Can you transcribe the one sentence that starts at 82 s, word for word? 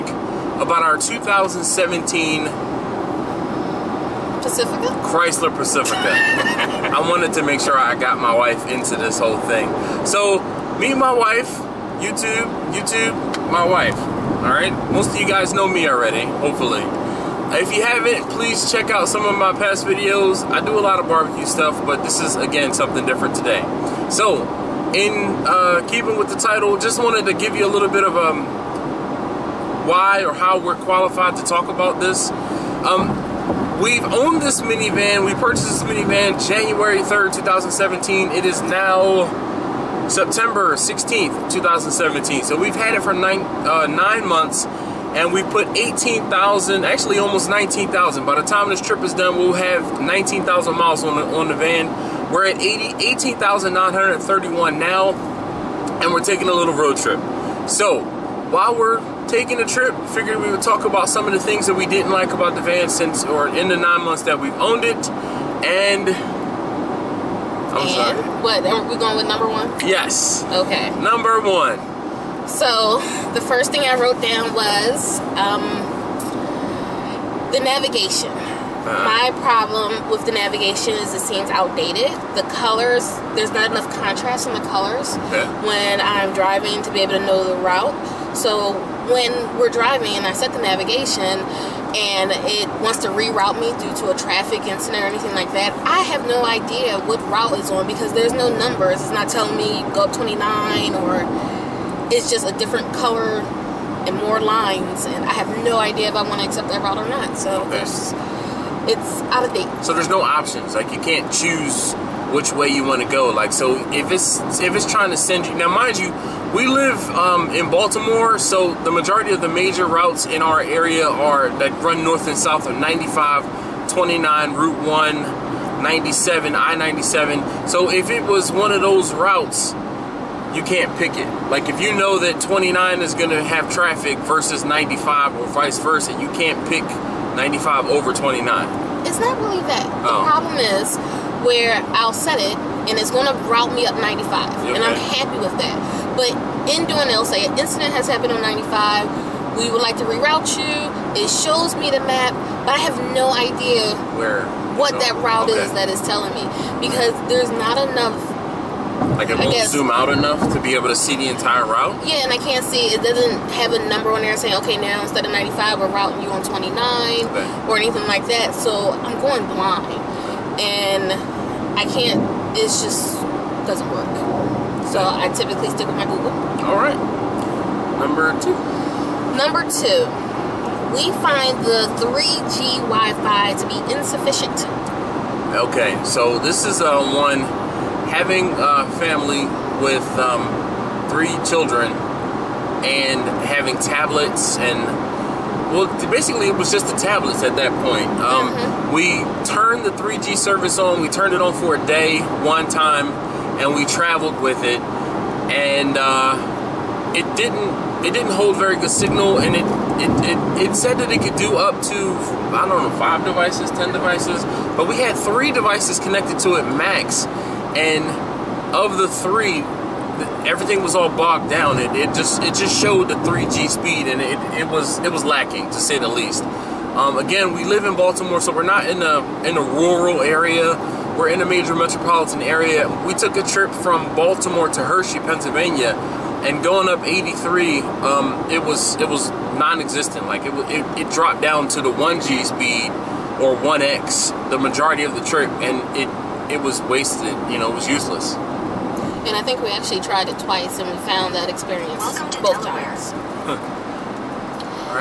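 The colors, there's not enough contrast in the colors okay.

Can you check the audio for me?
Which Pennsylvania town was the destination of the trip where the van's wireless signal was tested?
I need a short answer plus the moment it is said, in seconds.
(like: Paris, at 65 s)
Hershey, at 234 s.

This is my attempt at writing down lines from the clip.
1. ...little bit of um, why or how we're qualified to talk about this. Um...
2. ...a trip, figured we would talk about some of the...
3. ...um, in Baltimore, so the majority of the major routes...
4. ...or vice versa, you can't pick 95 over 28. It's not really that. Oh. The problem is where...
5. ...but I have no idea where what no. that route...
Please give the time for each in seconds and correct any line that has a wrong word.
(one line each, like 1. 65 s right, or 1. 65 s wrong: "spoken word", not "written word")
1. 27 s right
2. 59 s right
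3. 117 s right
4. 135 s wrong: "29", not "28"
5. 152 s right.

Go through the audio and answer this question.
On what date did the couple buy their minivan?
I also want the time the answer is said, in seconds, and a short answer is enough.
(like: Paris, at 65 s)
January 3rd, 2017, at 36 s.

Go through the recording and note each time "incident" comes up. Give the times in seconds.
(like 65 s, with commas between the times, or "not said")
94 s, 147 s.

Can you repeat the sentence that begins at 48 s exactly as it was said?
By the time this trip is done, we'll have 19,000 miles on the, on the van.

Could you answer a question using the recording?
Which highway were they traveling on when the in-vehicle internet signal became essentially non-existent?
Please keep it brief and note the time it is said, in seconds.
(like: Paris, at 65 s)
83, at 237 s.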